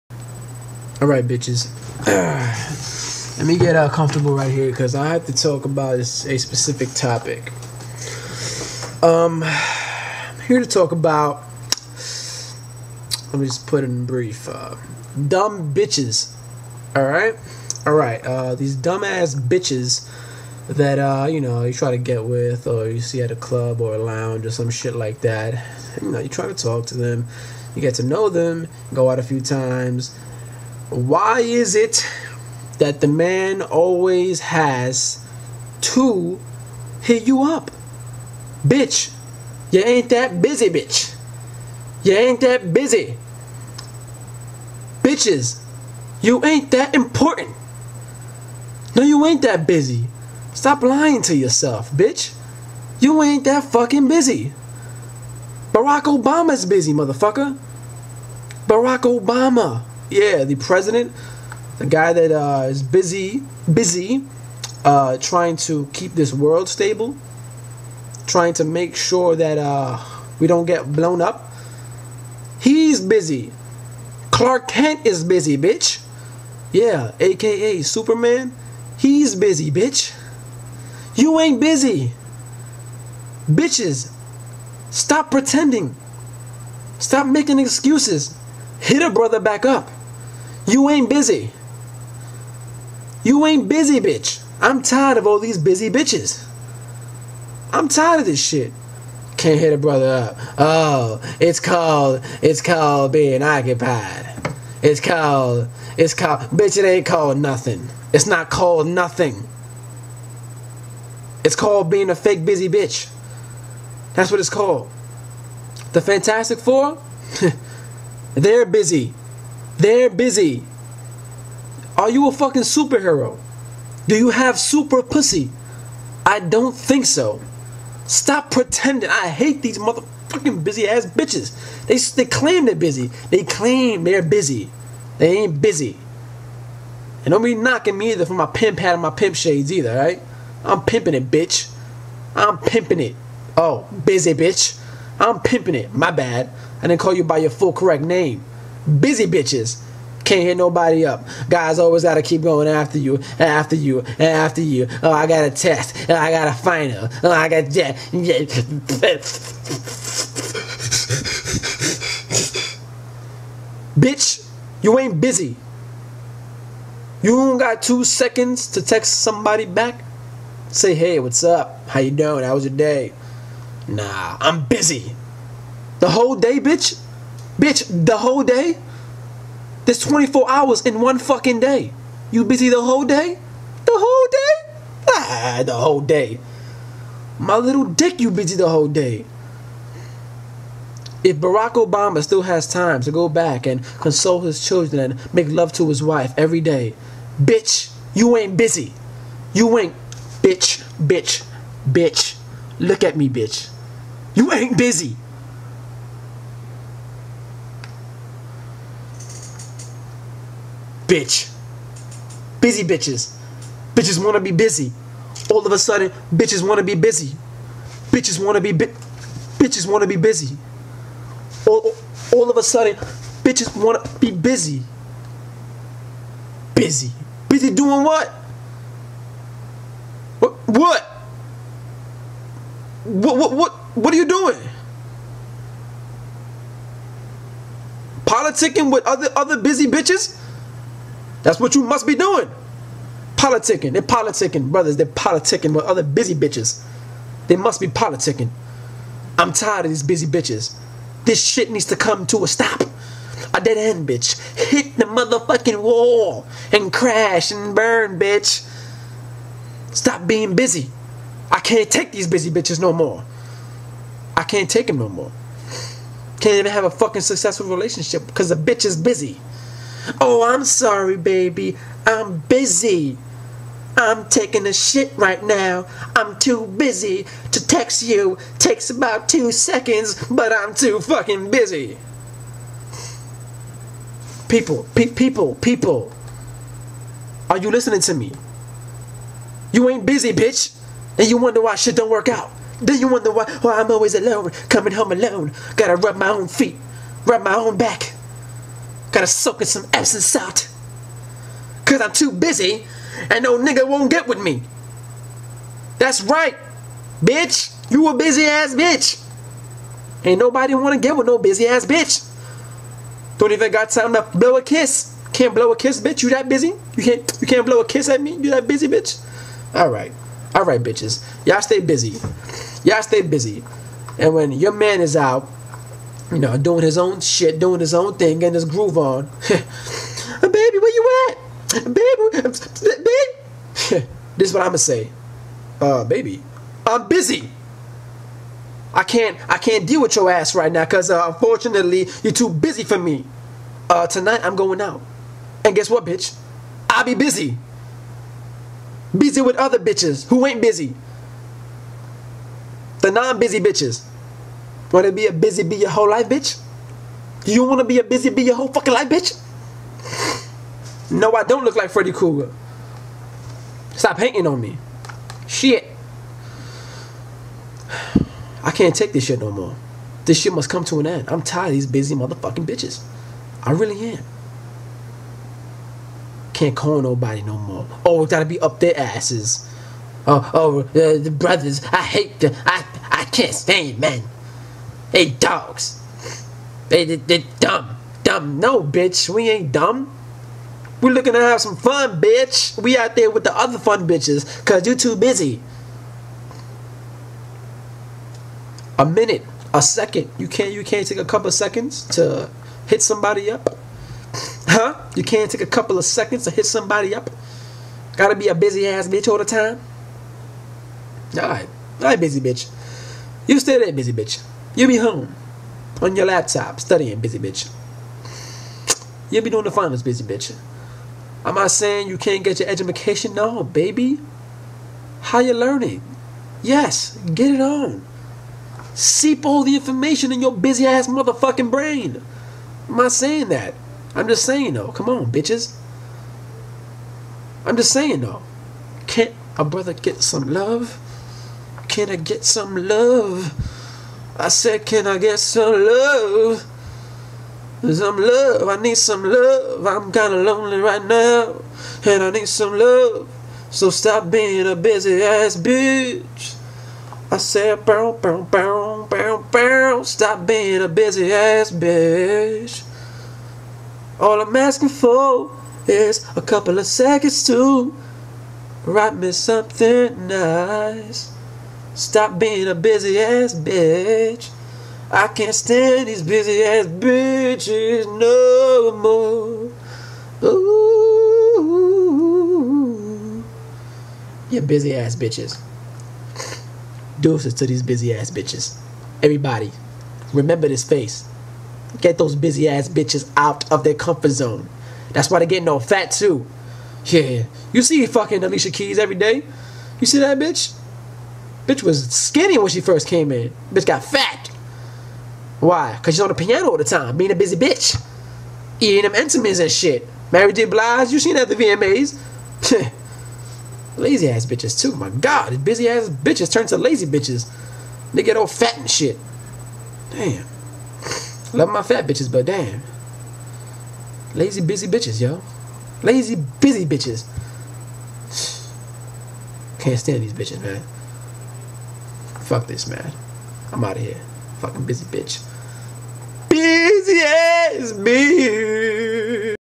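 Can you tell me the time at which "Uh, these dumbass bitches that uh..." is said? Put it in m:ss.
0:18.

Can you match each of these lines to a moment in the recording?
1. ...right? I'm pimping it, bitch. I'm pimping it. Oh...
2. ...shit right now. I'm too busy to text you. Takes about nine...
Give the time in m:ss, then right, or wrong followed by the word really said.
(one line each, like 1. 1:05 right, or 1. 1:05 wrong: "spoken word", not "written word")
1. 2:19 right
2. 4:34 wrong: "two", not "nine".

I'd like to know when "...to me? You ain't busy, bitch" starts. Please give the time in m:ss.
4:48.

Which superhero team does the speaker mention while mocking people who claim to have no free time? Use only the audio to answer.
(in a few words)
The Fantastic Four.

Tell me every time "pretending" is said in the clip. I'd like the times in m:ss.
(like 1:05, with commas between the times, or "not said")
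1:25, 2:08.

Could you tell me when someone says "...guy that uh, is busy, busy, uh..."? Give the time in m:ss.
1:01.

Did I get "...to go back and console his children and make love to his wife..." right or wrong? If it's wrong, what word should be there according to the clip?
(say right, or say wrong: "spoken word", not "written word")
right.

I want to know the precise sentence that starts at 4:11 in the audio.
This shit needs to come to a stop.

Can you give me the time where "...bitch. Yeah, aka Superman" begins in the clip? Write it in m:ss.
1:15.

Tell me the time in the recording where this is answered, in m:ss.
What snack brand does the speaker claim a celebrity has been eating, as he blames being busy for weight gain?
8:29.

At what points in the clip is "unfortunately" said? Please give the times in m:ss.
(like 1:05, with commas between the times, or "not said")
5:41.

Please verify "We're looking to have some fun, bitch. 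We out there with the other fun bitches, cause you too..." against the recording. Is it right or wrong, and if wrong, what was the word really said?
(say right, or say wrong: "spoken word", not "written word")
right.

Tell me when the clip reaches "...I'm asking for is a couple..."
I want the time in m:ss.
7:44.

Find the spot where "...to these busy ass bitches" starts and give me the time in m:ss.
8:07.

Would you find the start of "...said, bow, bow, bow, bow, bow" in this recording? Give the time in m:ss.
7:37.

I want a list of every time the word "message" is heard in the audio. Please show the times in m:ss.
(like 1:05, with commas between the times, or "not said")
not said.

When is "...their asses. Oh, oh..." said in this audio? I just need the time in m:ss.
6:18.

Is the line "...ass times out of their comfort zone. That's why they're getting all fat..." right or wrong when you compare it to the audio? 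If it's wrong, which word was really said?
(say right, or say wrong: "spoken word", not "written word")
wrong: "bitches", not "times".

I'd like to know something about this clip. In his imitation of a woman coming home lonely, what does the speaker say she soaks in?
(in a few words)
Epsom salt.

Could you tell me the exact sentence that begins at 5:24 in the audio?
And when your man is out, you know, doing his own shit, doing his own thing, getting his groove on.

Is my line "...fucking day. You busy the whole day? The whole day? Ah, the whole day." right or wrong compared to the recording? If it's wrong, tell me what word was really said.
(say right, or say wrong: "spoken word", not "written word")
right.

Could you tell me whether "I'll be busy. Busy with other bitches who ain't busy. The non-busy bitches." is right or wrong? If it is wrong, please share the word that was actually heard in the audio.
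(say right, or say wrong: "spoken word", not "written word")
right.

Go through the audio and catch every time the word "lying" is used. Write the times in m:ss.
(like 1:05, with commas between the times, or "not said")
0:50.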